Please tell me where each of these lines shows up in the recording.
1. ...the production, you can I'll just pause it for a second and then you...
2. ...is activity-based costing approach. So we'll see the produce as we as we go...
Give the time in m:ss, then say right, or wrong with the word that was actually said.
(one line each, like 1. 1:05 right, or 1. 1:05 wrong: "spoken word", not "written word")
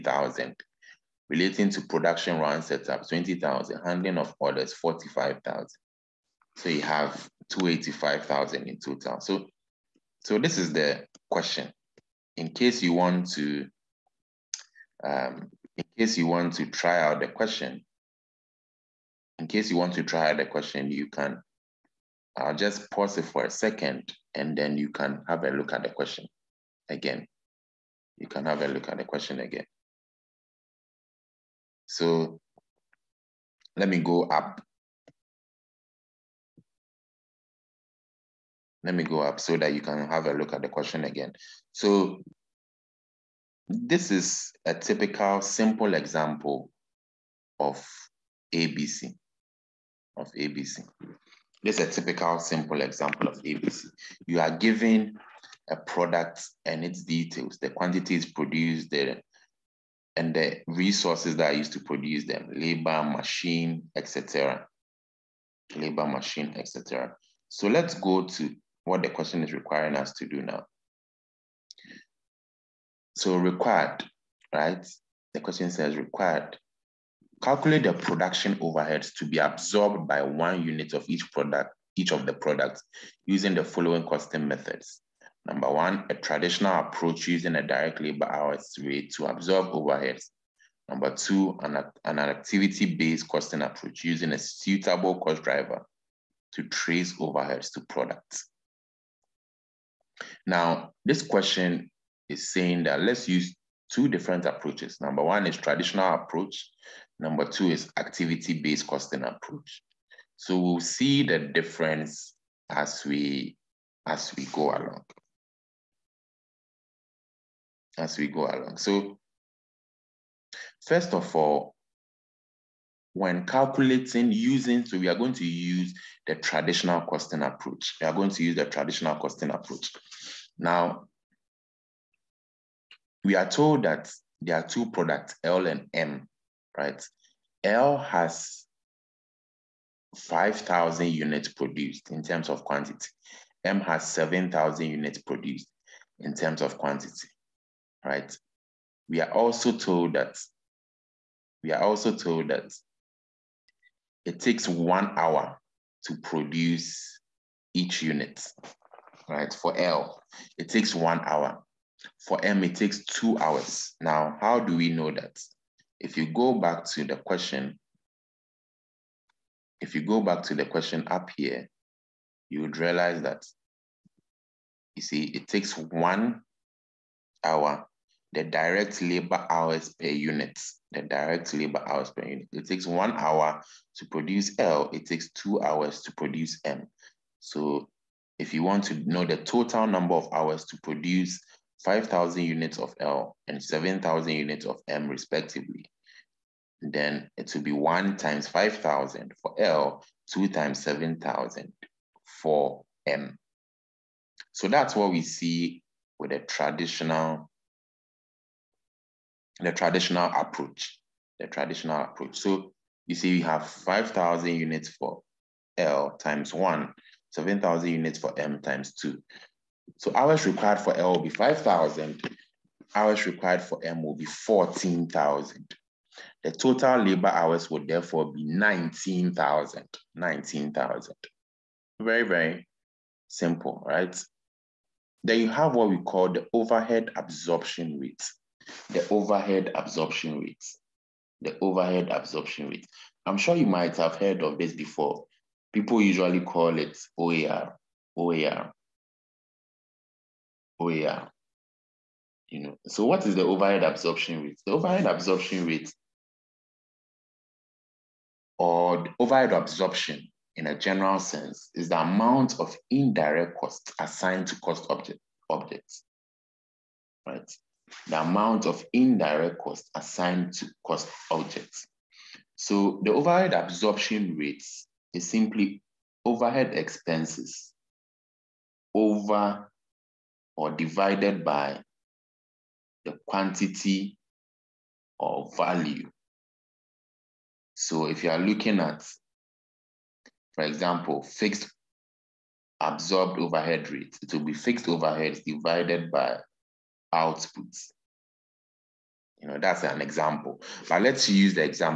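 1. 0:20 wrong: "question", not "production"
2. 1:47 wrong: "difference", not "produce".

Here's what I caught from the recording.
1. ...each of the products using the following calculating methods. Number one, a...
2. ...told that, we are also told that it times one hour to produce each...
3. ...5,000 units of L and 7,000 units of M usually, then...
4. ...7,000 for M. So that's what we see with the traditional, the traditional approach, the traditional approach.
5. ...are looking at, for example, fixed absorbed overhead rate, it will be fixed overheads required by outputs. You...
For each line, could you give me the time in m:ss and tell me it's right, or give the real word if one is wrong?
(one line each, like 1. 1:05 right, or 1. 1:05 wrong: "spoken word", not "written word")
1. 1:21 wrong: "costing", not "calculating"
2. 2:29 wrong: "takes", not "times"
3. 3:11 wrong: "respectively", not "usually"
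4. 3:20 right
5. 4:48 wrong: "divided", not "required".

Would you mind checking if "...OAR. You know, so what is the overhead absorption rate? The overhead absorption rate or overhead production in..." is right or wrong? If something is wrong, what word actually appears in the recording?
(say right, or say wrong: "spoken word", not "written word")
wrong: "absorption", not "production".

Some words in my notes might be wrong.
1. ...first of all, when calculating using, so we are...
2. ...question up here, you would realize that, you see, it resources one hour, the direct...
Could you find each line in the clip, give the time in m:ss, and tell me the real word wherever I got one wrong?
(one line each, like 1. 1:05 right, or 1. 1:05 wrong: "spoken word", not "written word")
1. 2:00 right
2. 2:50 wrong: "takes", not "resources".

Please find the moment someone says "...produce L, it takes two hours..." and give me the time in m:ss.
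3:04.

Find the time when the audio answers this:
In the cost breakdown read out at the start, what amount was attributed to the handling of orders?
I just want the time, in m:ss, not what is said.
0:04.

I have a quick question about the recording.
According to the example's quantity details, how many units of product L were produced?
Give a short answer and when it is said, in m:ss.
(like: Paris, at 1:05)
5,000, at 2:17.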